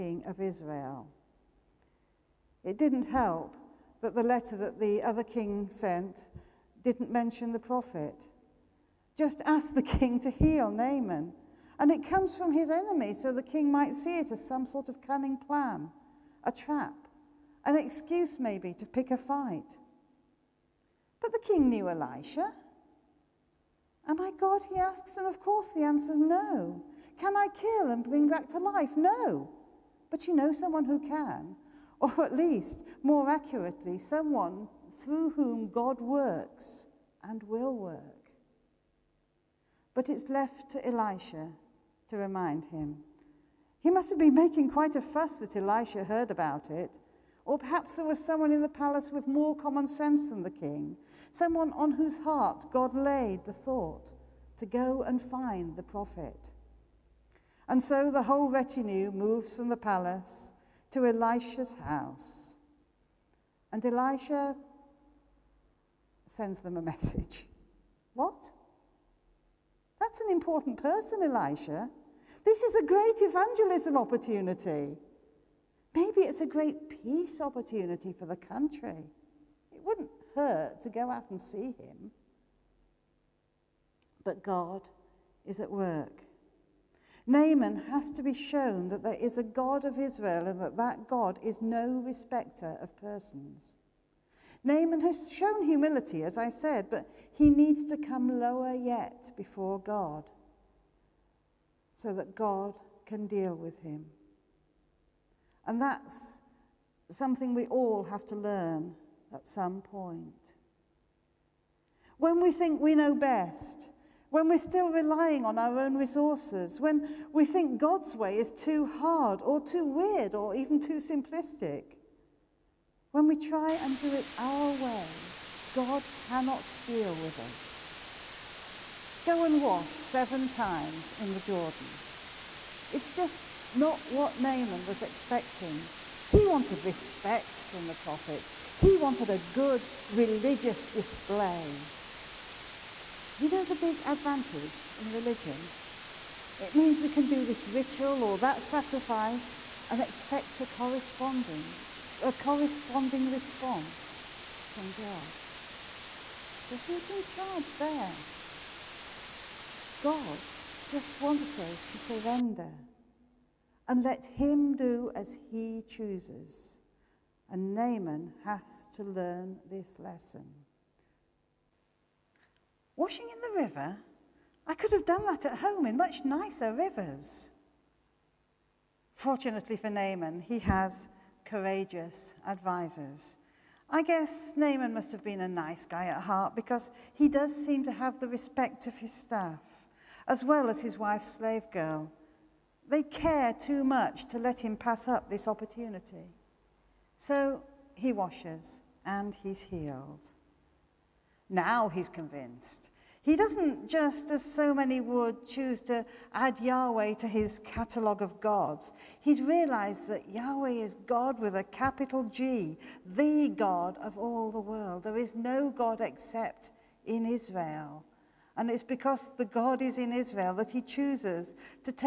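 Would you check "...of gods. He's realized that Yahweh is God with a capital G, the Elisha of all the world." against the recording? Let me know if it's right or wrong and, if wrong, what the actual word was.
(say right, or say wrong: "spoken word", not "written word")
wrong: "God", not "Elisha".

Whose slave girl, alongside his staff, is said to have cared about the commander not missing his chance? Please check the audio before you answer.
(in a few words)
His wife's.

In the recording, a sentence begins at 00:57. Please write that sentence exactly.
And so the whole retinue moves from the palace to Elisha's house.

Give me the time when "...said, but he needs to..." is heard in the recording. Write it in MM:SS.
01:36.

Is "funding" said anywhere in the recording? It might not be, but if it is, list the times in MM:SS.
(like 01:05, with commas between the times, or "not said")
not said.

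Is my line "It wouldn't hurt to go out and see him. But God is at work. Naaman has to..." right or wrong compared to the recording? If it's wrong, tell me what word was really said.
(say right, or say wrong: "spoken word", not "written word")
right.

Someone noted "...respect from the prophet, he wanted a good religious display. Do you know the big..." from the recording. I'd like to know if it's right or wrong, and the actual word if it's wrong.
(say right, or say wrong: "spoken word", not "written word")
right.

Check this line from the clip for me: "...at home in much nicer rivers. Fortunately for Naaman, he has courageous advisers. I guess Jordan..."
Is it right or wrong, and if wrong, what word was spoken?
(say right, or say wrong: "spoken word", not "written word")
wrong: "Naaman", not "Jordan".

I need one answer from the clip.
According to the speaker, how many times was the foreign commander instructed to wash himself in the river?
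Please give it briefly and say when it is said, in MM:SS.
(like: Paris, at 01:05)
7, at 02:09.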